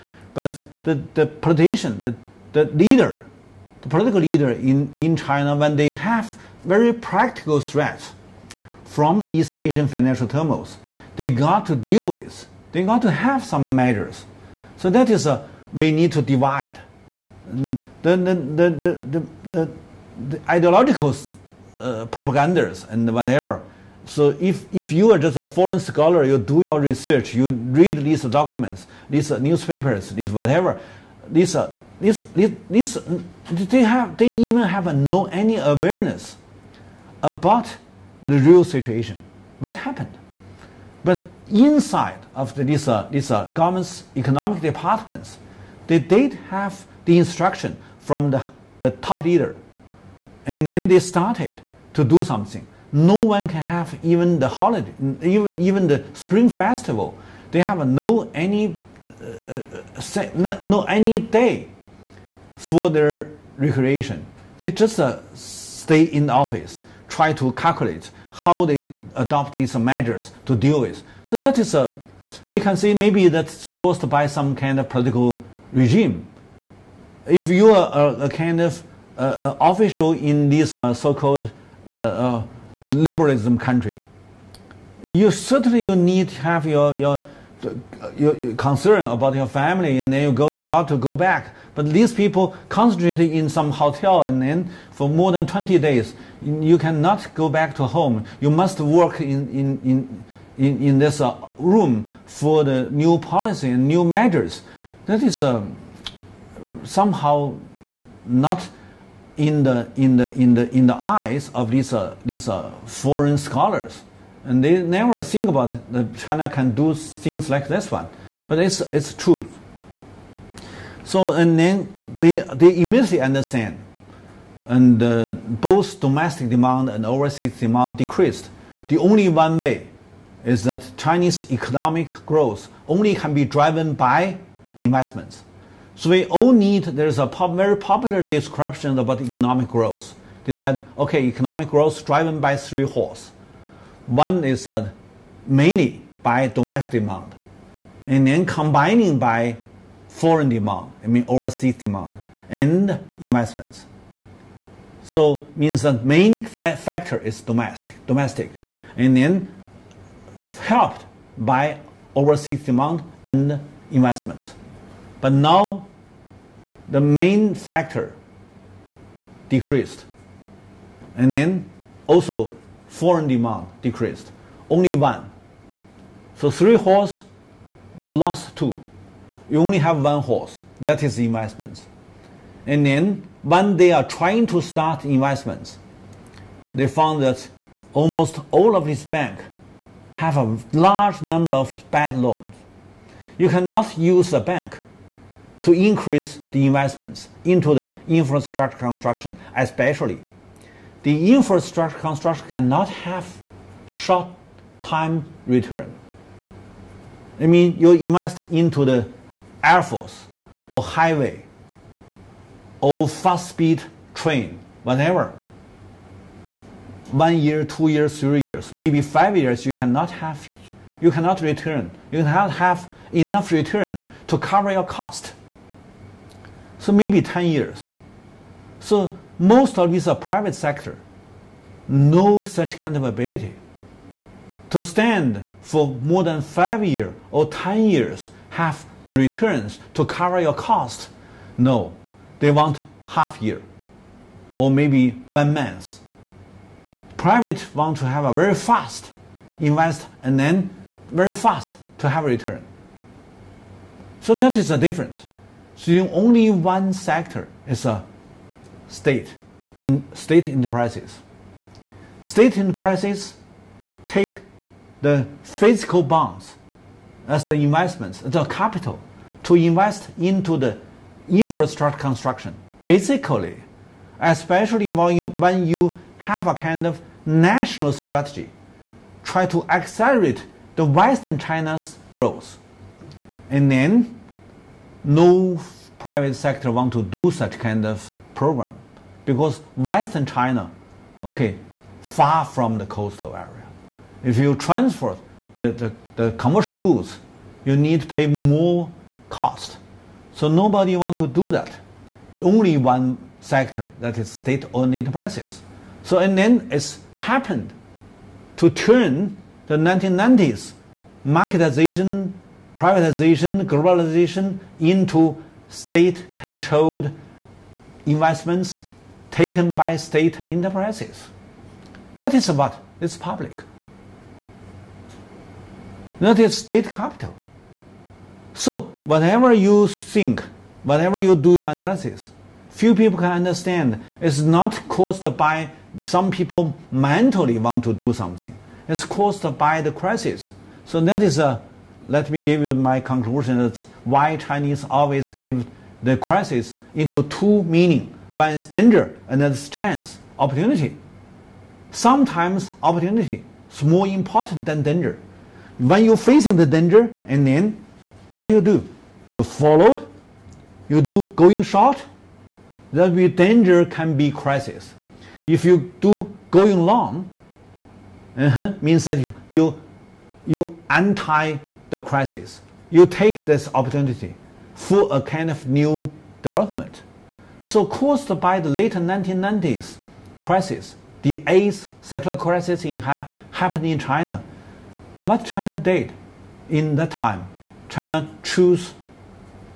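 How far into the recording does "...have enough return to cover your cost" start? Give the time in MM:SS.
03:42.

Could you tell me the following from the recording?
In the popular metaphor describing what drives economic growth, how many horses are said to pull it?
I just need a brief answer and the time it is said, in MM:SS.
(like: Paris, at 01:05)
3, at 02:22.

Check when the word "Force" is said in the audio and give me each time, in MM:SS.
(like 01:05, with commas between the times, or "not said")
03:29.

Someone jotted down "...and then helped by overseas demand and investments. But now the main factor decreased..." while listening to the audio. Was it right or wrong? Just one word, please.
right.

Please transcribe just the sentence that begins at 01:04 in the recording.
They just uh, stay in the office try to calculate how they adopt these measures to deal with.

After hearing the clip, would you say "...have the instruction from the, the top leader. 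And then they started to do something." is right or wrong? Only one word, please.
right.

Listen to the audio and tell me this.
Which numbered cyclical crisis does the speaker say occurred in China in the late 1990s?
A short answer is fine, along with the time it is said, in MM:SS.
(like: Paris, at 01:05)
eighth, at 06:21.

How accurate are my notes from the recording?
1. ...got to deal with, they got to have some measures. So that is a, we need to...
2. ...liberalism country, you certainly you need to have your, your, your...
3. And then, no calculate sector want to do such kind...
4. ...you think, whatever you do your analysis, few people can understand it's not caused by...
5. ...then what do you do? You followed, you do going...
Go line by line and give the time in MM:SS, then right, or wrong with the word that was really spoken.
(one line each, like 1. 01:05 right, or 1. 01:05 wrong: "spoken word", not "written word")
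1. 00:11 right
2. 01:22 right
3. 04:43 wrong: "private", not "calculate"
4. 05:29 right
5. 05:57 right.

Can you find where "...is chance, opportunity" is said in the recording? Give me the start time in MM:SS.
05:49.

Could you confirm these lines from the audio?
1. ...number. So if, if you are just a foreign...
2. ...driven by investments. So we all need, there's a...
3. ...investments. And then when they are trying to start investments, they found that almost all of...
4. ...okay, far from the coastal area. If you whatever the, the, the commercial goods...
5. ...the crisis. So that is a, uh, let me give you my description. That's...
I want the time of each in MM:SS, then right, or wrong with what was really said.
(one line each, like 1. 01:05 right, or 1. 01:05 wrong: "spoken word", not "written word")
1. 00:23 wrong: "whatever", not "number"
2. 02:13 right
3. 03:01 right
4. 04:51 wrong: "transfer", not "whatever"
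5. 05:39 wrong: "conclusion", not "description".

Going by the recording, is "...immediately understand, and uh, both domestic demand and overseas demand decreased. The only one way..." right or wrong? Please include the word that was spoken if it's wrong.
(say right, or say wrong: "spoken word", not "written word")
right.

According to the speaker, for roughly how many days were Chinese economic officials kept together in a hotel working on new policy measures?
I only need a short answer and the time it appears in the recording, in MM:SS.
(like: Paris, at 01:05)
more than 20 days, at 01:35.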